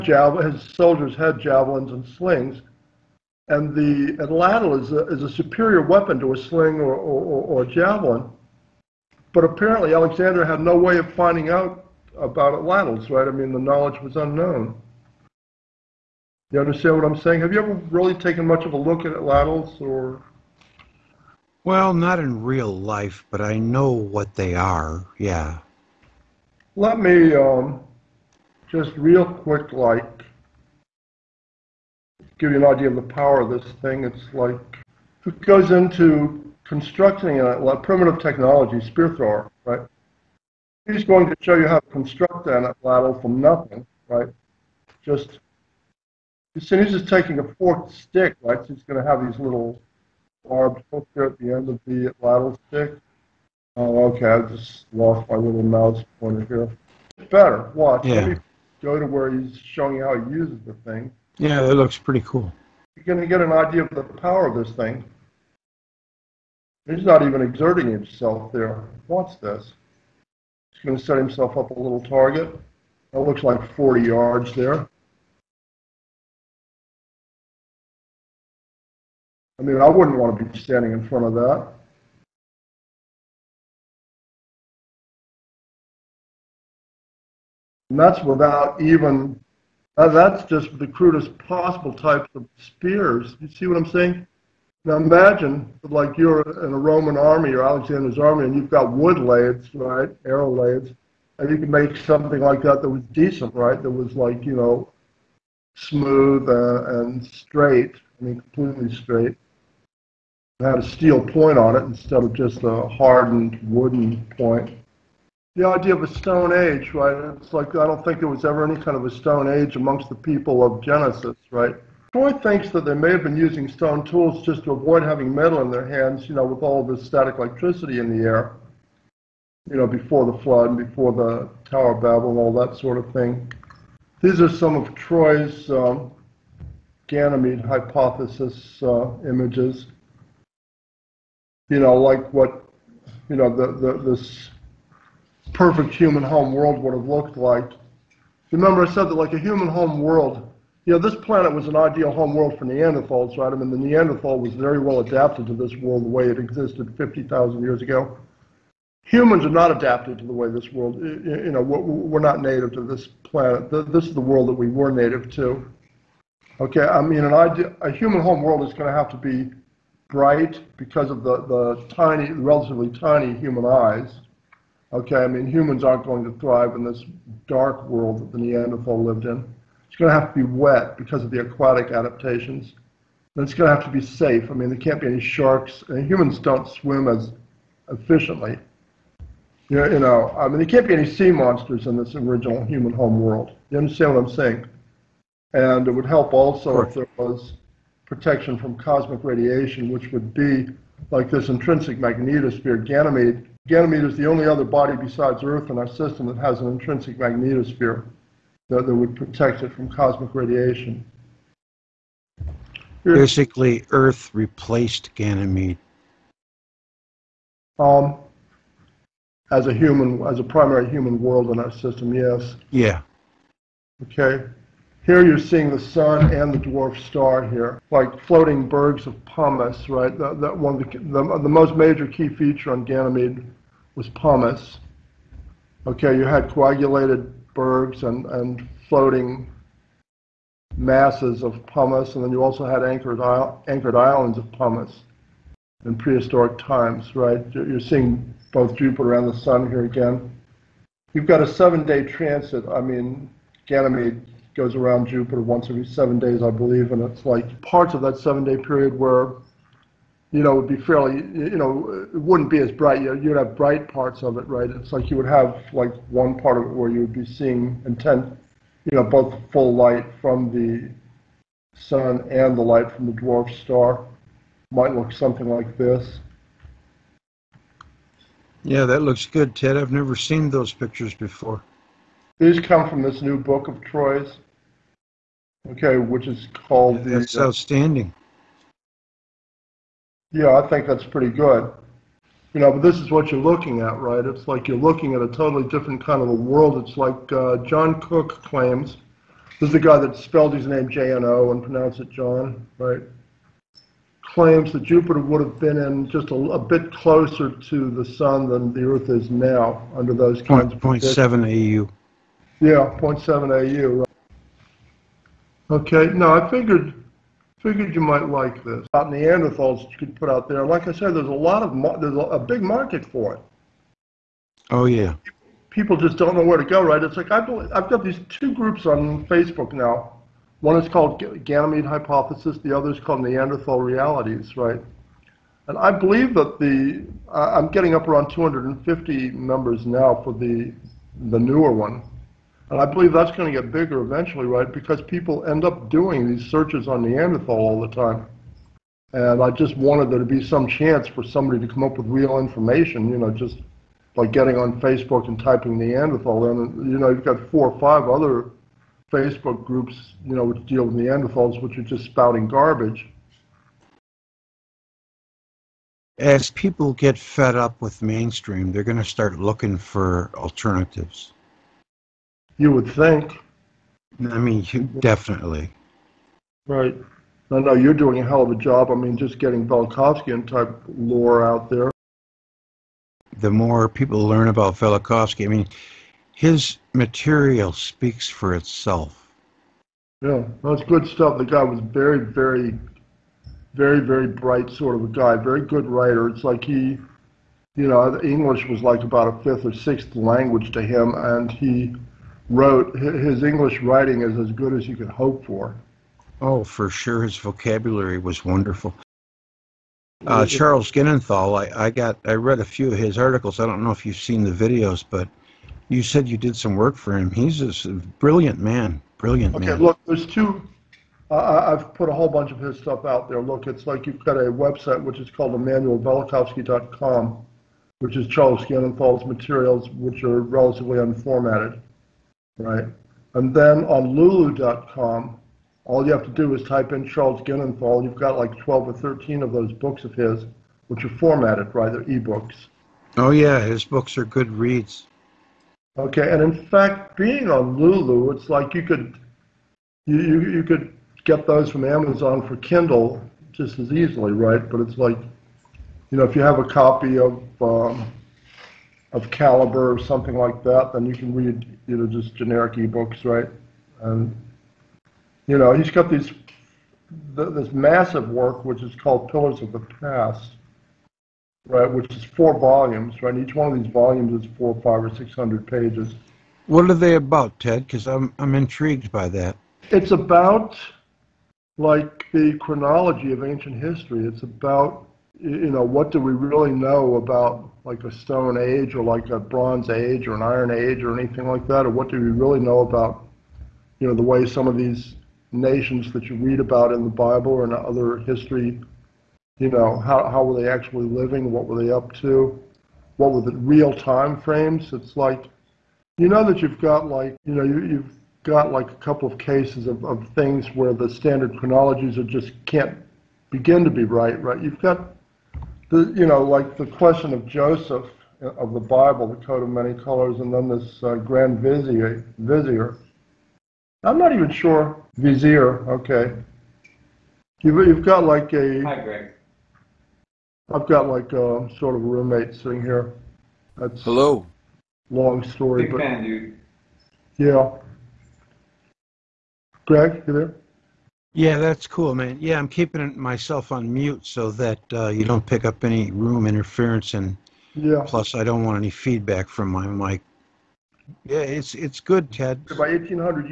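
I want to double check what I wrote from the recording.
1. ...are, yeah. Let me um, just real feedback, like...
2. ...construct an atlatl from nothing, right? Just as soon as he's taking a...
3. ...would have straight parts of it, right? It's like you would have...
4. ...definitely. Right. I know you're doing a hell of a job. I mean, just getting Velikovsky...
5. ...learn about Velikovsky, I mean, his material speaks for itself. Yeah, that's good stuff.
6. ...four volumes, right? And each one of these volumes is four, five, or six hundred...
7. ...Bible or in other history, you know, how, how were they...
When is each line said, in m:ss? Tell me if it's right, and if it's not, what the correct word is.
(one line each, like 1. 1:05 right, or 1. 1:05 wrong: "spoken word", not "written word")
1. 0:24 wrong: "quick", not "feedback"
2. 0:41 right
3. 4:23 wrong: "bright", not "straight"
4. 6:14 right
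5. 6:24 right
6. 7:52 right
7. 8:17 right.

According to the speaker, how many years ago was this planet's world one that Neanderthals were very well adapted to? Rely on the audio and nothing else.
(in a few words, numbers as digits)
50,000.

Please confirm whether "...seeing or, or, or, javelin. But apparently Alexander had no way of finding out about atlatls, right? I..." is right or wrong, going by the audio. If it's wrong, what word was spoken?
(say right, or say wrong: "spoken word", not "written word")
wrong: "sling", not "seeing".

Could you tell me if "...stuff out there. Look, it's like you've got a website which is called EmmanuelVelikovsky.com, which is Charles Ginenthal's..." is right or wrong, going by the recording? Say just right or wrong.
right.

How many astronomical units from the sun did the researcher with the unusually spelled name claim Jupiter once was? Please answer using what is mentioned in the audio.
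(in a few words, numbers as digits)
0.7 AU.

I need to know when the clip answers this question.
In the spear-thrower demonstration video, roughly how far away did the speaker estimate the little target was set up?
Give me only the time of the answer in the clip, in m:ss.
1:13.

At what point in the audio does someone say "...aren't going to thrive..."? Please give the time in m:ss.
2:55.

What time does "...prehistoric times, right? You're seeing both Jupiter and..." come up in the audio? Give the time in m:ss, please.
4:05.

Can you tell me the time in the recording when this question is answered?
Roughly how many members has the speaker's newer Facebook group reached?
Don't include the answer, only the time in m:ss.
5:38.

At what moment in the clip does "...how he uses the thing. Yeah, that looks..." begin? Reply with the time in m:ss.
1:00.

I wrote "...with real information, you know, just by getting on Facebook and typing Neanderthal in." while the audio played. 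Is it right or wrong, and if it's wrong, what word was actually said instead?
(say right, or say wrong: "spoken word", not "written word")
right.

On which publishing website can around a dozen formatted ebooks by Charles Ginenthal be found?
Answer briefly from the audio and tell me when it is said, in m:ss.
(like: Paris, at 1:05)
Lulu.com, at 7:14.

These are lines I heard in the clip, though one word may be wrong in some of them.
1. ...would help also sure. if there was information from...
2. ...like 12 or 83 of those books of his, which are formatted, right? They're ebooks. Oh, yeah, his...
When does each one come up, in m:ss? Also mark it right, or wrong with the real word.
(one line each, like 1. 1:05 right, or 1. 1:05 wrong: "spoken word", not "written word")
1. 3:15 wrong: "protection", not "information"
2. 7:18 wrong: "13", not "83".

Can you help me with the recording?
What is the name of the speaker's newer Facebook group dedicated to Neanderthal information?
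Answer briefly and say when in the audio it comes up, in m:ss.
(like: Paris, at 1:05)
Neanderthal Realities, at 5:33.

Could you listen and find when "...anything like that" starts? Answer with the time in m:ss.
8:11.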